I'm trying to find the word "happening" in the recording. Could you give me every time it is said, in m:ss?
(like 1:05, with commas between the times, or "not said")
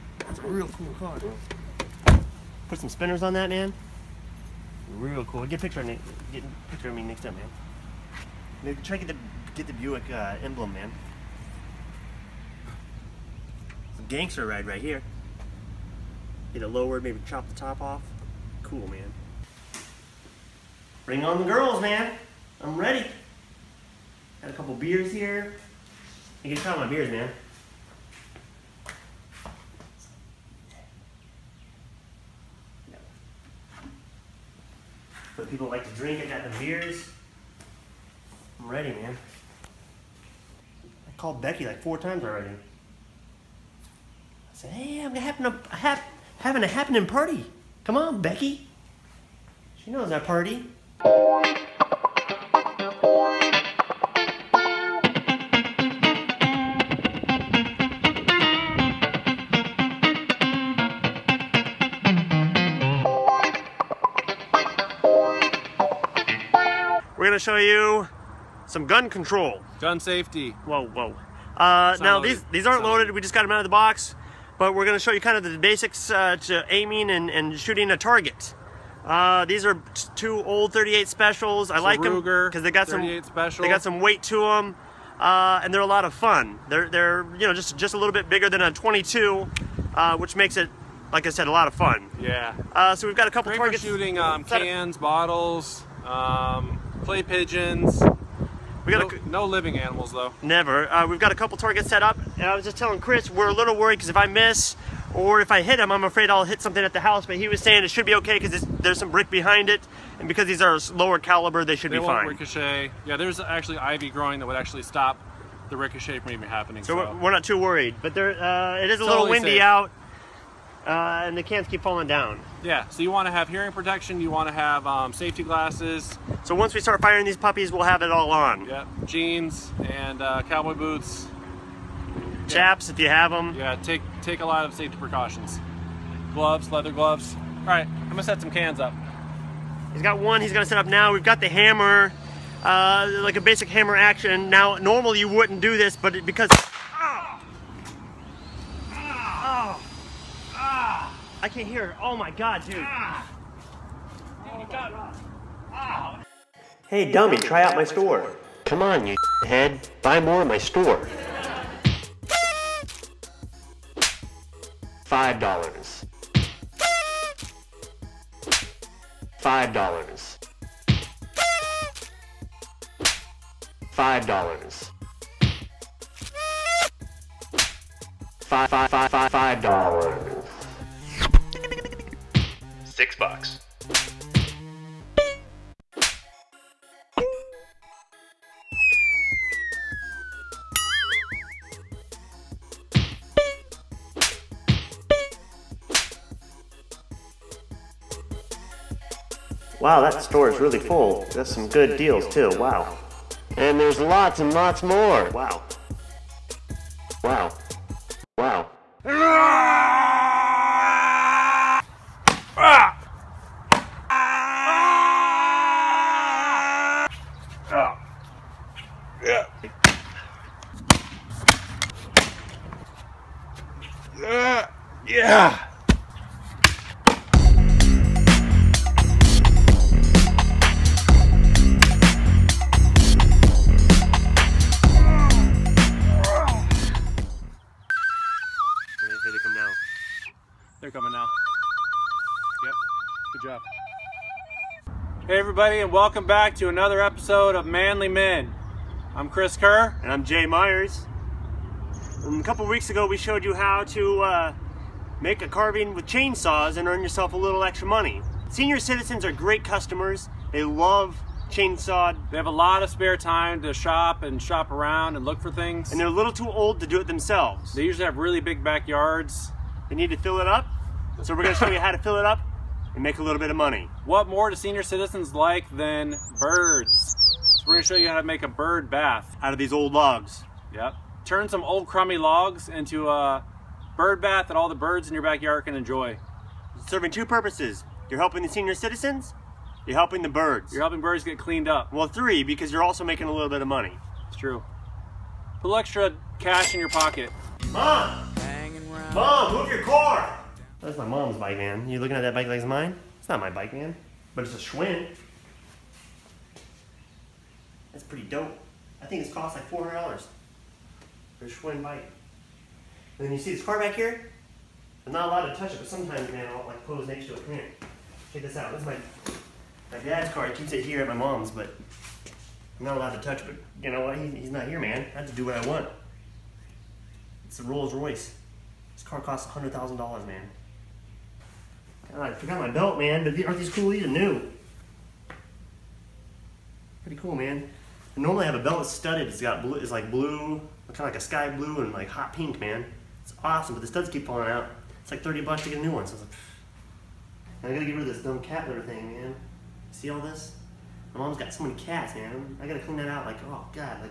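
0:46, 1:56.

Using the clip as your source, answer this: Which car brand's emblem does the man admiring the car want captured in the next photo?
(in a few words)
Buick.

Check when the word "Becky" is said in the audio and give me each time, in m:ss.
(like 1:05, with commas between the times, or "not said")
0:41, 0:48.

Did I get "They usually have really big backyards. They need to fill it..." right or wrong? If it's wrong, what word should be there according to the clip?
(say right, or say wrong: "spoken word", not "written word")
right.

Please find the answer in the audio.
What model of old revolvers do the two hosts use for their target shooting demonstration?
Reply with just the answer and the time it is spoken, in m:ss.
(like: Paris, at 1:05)
38 specials, at 1:20.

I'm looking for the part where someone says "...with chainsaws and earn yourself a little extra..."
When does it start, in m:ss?
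4:15.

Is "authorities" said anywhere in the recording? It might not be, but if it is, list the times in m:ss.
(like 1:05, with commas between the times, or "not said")
not said.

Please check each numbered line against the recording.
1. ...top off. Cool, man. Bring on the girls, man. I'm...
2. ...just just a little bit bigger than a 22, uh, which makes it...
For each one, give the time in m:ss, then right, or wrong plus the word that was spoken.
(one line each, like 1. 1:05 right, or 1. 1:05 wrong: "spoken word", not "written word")
1. 0:17 right
2. 1:27 right.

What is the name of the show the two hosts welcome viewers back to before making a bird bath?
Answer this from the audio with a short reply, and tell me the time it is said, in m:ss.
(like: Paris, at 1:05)
Manly Men, at 4:07.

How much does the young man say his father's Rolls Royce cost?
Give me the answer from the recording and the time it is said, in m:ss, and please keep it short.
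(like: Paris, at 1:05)
$100,000, at 5:29.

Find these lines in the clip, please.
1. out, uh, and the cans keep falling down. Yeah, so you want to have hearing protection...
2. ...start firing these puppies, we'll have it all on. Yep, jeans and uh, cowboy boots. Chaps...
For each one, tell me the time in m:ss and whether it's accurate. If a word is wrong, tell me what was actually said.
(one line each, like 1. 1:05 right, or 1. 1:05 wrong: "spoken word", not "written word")
1. 1:59 right
2. 2:06 right.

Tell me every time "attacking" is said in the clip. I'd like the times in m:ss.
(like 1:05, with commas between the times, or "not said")
not said.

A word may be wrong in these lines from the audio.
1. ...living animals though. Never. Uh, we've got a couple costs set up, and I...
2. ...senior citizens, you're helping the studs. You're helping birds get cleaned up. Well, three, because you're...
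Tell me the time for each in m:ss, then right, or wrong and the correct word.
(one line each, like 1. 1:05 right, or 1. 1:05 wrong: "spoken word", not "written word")
1. 1:39 wrong: "targets", not "costs"
2. 4:48 wrong: "birds", not "studs".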